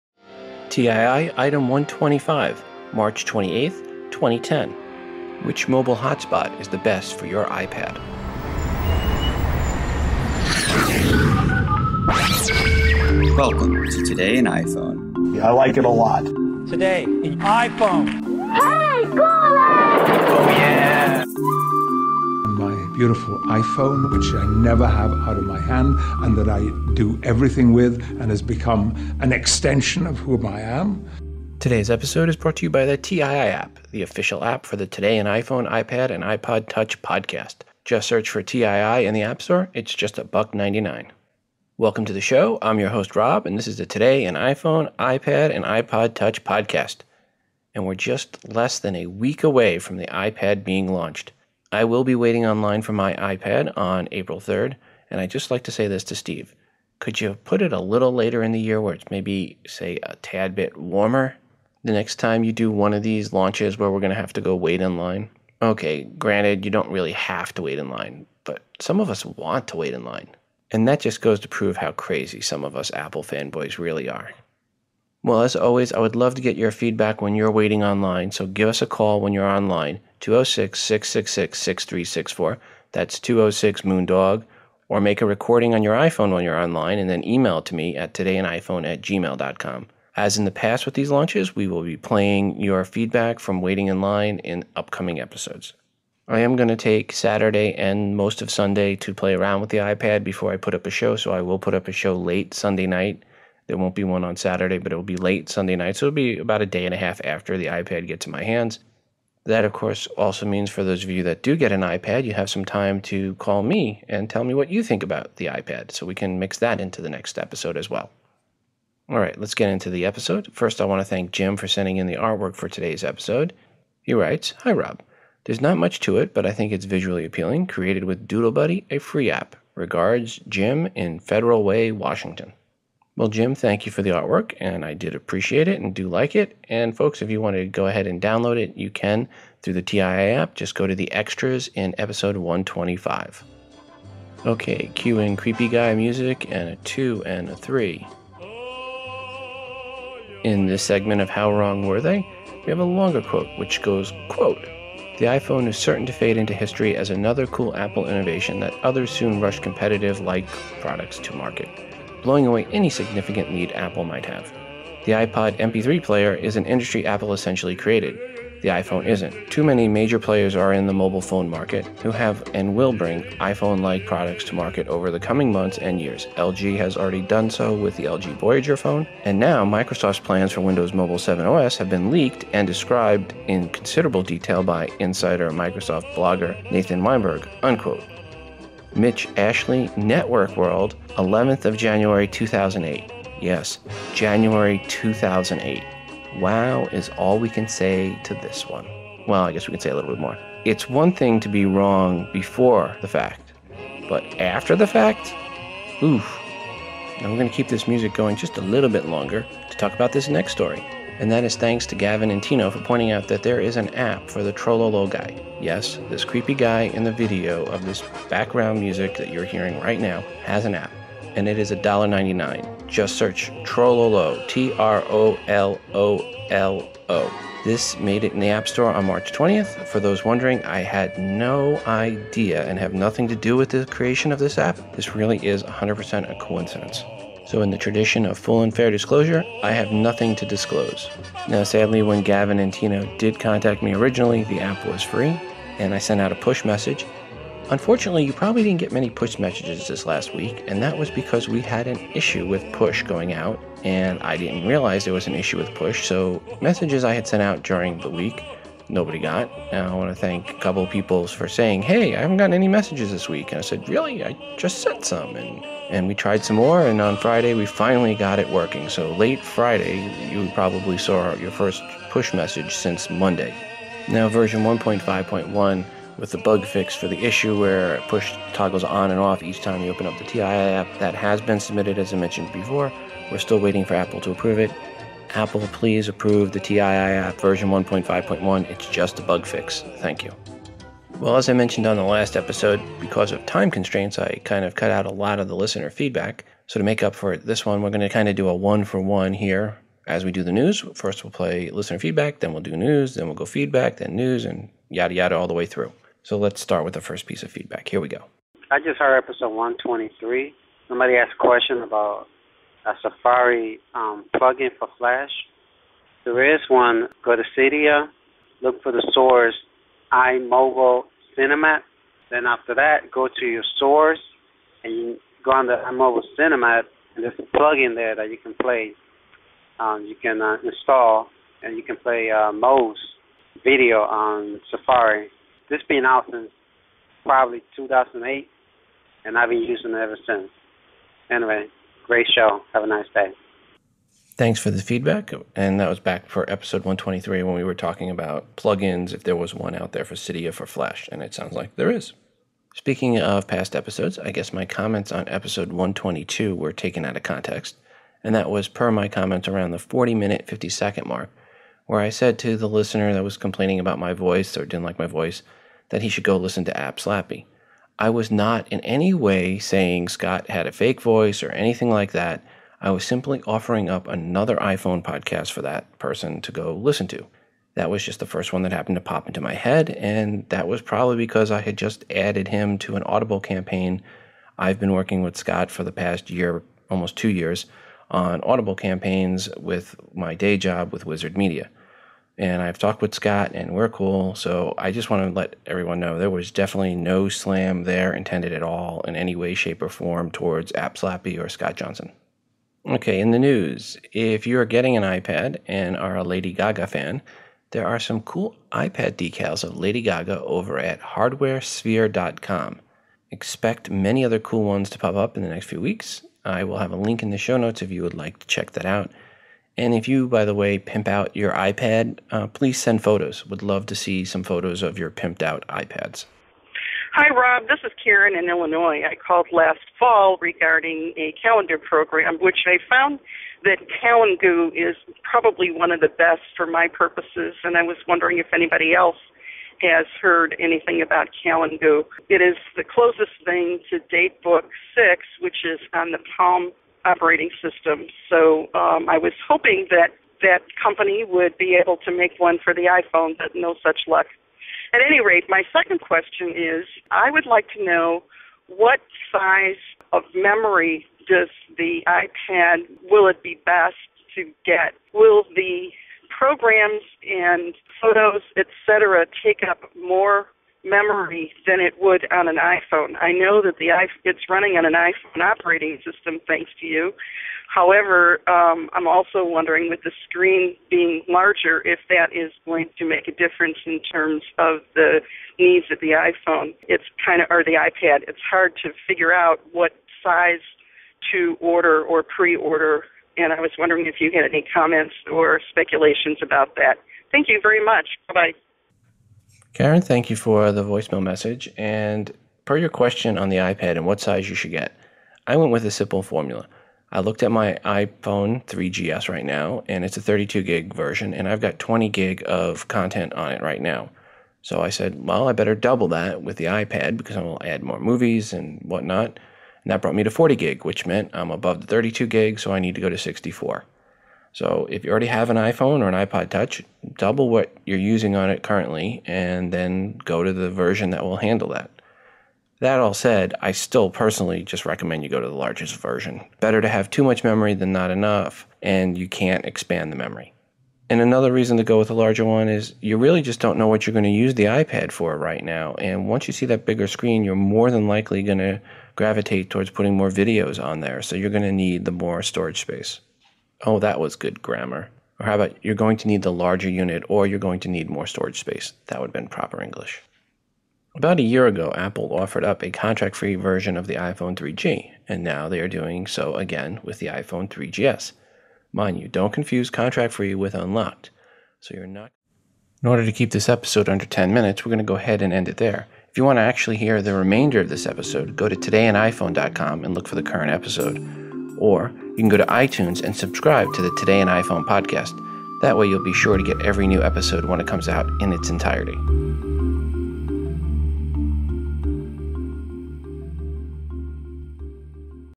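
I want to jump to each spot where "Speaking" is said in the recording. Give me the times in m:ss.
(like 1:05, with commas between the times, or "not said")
5:52.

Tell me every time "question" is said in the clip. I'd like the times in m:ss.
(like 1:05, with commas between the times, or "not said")
5:11, 7:36, 8:22.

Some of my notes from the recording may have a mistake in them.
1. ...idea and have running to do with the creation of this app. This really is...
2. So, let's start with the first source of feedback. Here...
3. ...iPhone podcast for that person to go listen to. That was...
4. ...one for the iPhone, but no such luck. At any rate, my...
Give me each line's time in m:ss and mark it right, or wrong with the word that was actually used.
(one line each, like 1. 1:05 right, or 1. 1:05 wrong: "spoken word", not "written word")
1. 3:51 wrong: "nothing", not "running"
2. 5:06 wrong: "piece", not "source"
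3. 6:14 right
4. 7:32 right.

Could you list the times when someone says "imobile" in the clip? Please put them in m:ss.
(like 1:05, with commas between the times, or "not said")
5:20, 5:25.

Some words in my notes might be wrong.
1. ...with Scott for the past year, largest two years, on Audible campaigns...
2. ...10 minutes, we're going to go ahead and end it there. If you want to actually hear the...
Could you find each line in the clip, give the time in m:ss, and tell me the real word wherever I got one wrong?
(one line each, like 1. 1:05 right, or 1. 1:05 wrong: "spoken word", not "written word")
1. 6:25 wrong: "almost", not "largest"
2. 9:34 right.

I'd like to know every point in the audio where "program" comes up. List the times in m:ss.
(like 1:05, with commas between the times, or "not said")
7:11, 7:46.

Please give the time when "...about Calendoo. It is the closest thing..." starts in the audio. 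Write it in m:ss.
7:21.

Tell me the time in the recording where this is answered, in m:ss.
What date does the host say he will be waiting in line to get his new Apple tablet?
0:54.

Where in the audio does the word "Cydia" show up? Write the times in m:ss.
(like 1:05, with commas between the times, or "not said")
5:17, 5:50.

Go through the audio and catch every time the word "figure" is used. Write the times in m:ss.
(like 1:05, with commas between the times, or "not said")
8:09.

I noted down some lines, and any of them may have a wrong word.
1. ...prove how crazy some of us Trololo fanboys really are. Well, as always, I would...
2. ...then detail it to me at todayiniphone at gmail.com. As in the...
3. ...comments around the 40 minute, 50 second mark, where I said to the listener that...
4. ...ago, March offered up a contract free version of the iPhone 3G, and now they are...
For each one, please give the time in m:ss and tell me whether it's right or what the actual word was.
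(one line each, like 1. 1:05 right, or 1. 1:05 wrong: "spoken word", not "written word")
1. 1:11 wrong: "Apple", not "Trololo"
2. 1:27 wrong: "email", not "detail"
3. 5:59 right
4. 9:21 wrong: "Apple", not "March".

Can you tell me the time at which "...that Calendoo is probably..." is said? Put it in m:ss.
7:13.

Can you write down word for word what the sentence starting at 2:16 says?
And folks, if you want to go ahead and download it, you can through the TII app.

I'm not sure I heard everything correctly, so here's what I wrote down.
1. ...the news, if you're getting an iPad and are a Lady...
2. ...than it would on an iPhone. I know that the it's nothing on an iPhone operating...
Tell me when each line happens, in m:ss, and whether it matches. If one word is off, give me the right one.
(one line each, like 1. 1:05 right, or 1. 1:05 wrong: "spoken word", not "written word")
1. 6:43 right
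2. 7:51 wrong: "running", not "nothing".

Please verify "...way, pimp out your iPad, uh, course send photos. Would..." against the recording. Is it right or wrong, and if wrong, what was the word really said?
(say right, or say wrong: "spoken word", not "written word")
wrong: "please", not "course".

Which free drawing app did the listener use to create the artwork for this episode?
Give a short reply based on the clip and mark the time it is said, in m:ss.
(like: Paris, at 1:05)
Doodle Buddy, at 2:08.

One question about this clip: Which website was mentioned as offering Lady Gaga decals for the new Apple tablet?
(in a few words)
hardwaresphere.com.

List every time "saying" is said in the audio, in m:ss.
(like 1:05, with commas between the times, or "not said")
4:21, 6:09.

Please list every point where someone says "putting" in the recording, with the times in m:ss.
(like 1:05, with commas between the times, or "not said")
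9:09.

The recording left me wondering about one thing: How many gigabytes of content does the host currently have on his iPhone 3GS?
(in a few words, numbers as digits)
20.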